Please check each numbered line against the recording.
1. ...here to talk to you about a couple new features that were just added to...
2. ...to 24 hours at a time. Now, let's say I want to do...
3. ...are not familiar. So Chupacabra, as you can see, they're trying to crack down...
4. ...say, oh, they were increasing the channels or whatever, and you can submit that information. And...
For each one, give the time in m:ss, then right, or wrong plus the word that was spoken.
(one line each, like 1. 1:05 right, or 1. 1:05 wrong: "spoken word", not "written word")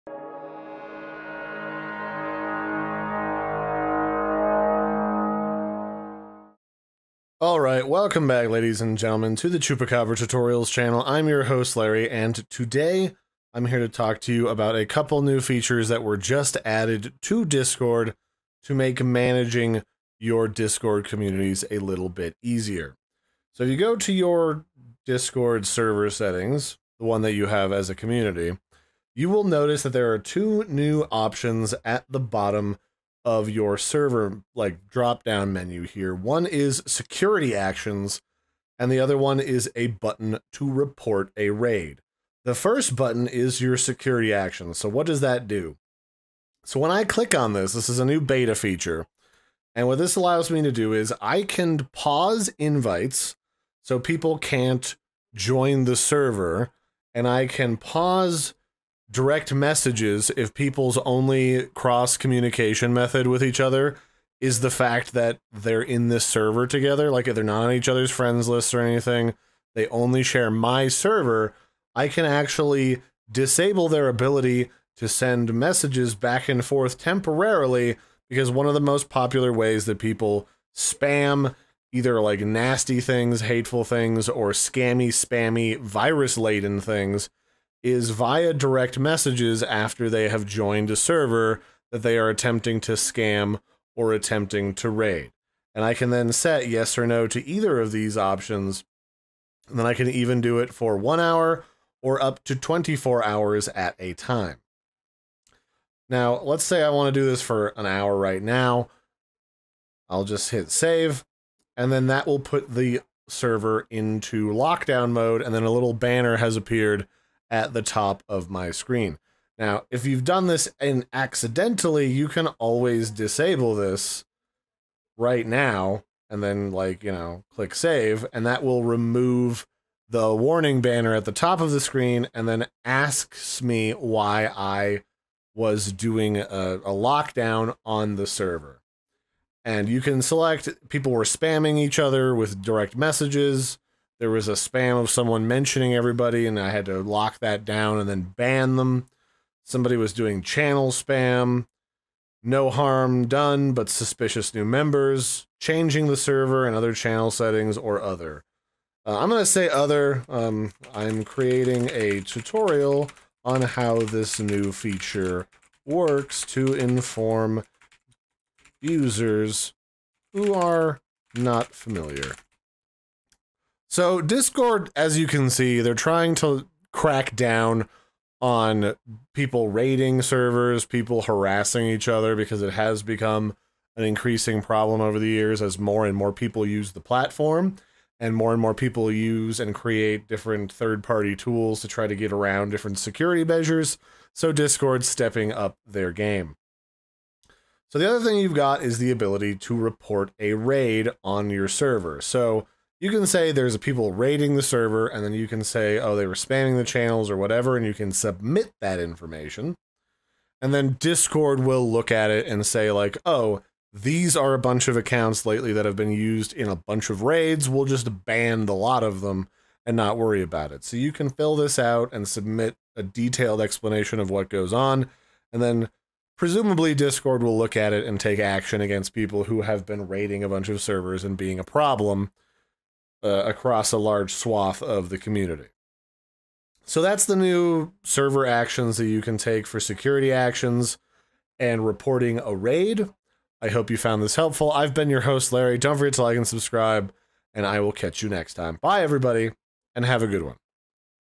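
1. 0:13 right
2. 1:42 right
3. 2:50 wrong: "Discord", not "Chupacabra"
4. 3:25 wrong: "spamming", not "increasing".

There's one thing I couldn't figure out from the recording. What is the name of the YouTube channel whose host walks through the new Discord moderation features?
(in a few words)
Chupacabra Tutorials.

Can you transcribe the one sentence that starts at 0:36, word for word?
One is security actions, and the other one is a button to report a raid.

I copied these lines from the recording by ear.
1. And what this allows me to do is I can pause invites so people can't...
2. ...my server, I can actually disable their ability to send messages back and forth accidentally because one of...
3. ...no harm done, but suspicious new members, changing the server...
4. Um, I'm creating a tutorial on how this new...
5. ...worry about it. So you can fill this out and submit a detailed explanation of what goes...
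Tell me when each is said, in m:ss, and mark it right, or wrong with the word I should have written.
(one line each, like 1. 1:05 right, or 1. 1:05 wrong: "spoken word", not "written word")
1. 0:49 right
2. 1:10 wrong: "temporarily", not "accidentally"
3. 2:32 right
4. 2:40 right
5. 3:40 right.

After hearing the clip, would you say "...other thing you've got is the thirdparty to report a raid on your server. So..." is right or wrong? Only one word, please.
wrong.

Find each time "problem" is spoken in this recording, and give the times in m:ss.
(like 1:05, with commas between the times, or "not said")
3:04, 3:51.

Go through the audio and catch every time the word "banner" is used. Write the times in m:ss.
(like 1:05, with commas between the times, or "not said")
1:55, 2:10.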